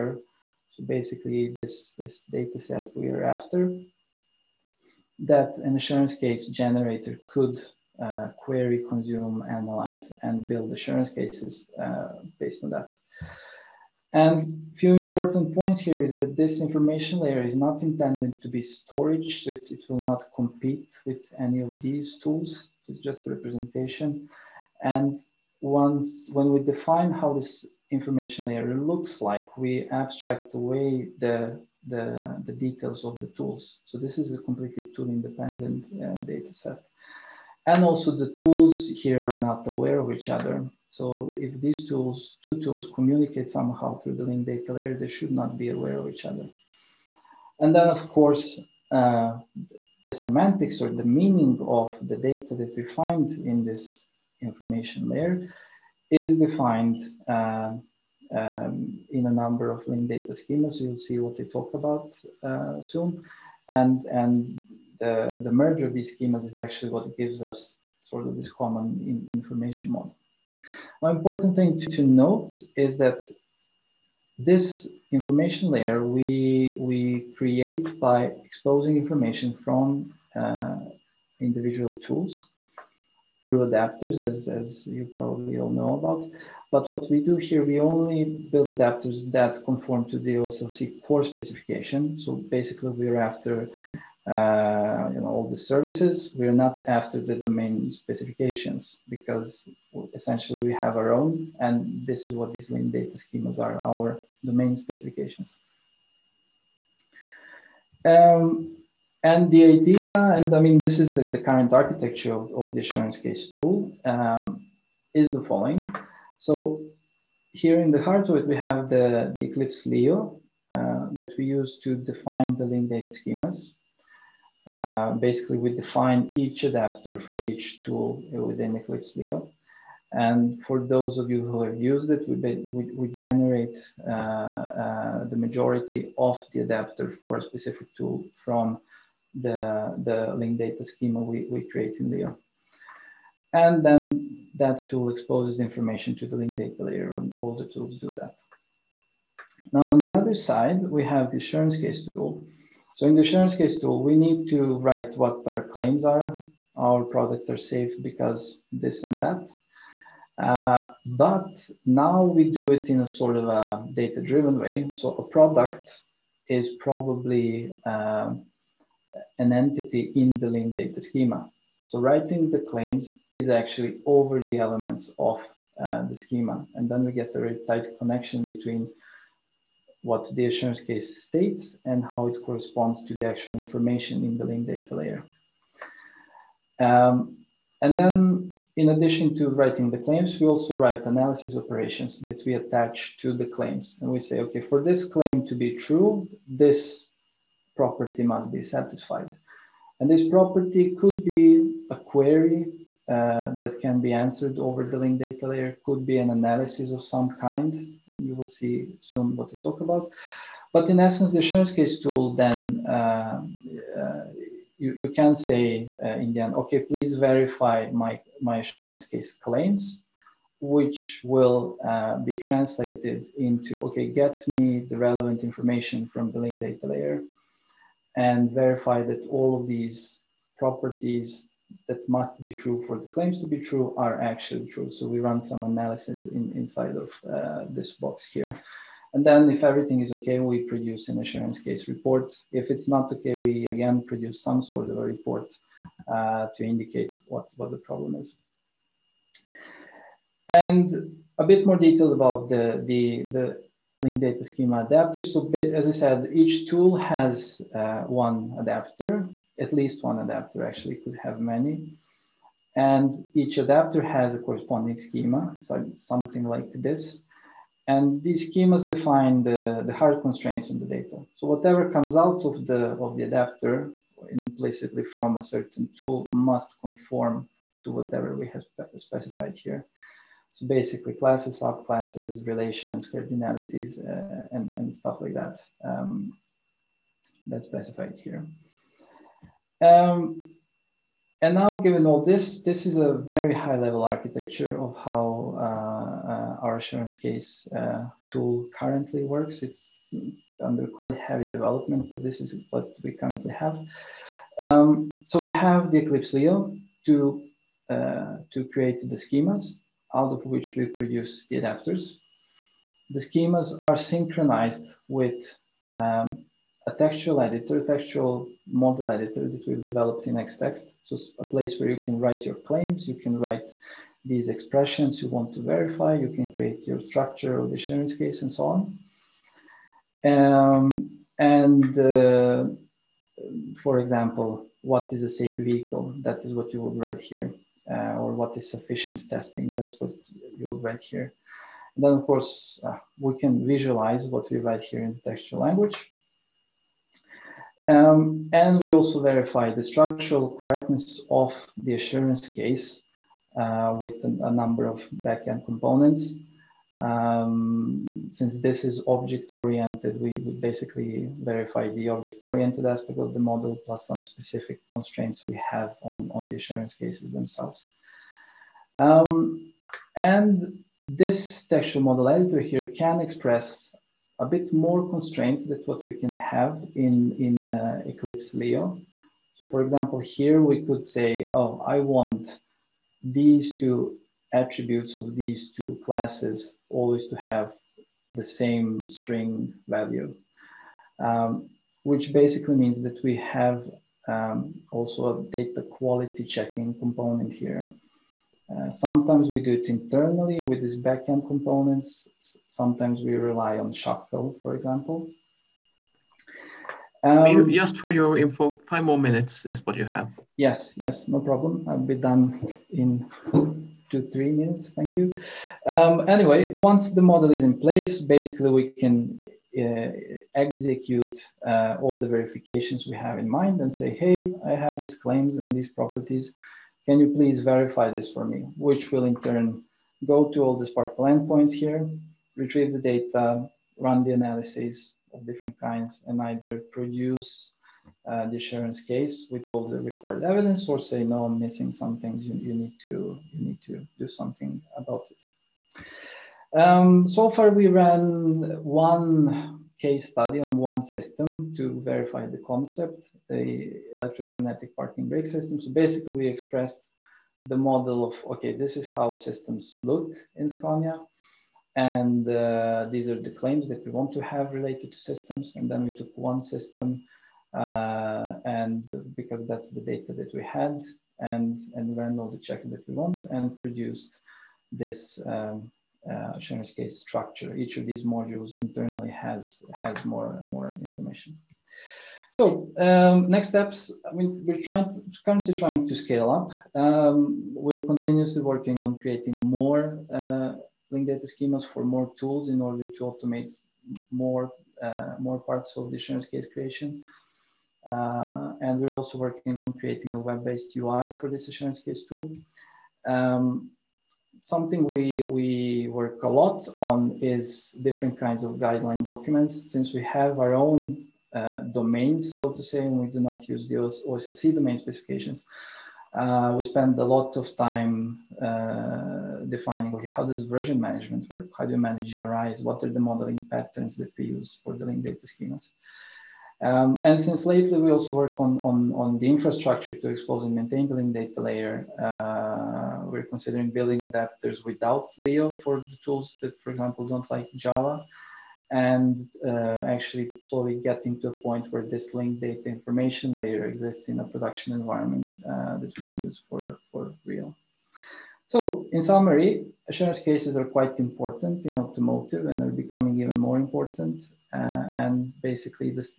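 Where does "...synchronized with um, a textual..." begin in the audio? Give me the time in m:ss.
5:13.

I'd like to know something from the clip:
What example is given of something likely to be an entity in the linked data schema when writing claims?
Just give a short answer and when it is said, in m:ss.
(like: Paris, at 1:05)
A product, at 2:45.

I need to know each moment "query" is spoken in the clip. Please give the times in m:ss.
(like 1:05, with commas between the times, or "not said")
0:08, 3:21.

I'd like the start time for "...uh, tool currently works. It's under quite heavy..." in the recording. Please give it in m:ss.
4:57.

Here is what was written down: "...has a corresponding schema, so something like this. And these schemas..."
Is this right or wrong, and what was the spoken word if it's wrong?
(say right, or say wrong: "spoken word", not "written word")
right.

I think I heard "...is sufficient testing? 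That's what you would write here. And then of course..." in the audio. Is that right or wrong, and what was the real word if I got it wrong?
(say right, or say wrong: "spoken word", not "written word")
right.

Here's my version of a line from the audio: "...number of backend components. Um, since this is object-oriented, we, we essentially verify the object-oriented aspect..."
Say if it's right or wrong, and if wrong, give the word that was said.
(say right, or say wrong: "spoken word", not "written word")
wrong: "basically", not "essentially".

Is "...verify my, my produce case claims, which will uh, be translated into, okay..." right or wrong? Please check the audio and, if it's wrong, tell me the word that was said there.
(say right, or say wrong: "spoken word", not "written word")
wrong: "assurance", not "produce".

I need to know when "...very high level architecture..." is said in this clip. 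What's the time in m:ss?
4:53.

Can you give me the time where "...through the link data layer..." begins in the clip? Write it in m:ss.
0:43.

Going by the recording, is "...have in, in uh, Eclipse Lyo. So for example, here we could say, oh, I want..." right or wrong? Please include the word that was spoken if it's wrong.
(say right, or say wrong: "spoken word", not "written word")
right.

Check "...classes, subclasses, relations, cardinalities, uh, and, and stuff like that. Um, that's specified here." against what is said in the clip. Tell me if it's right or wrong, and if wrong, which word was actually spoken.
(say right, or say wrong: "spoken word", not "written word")
right.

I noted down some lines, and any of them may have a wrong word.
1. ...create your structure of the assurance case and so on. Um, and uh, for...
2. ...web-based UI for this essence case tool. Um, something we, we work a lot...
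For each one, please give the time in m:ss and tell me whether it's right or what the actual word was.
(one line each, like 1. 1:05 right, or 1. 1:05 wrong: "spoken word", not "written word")
1. 5:26 right
2. 8:20 wrong: "assurance", not "essence".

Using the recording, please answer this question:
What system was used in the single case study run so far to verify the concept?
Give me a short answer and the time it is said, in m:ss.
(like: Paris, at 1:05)
Electromagnetic parking brake system, at 7:34.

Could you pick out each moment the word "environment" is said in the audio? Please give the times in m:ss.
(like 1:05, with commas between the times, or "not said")
9:04.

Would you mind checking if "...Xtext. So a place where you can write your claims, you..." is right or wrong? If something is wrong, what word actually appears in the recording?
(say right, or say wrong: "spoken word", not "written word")
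right.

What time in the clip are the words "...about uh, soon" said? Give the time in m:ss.
1:01.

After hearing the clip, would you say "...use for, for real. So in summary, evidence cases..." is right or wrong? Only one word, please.
wrong.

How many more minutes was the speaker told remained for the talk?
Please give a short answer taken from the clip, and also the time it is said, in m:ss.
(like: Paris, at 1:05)
5, at 6:48.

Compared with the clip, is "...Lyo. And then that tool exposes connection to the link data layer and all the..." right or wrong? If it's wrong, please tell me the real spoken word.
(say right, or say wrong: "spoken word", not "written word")
wrong: "information", not "connection".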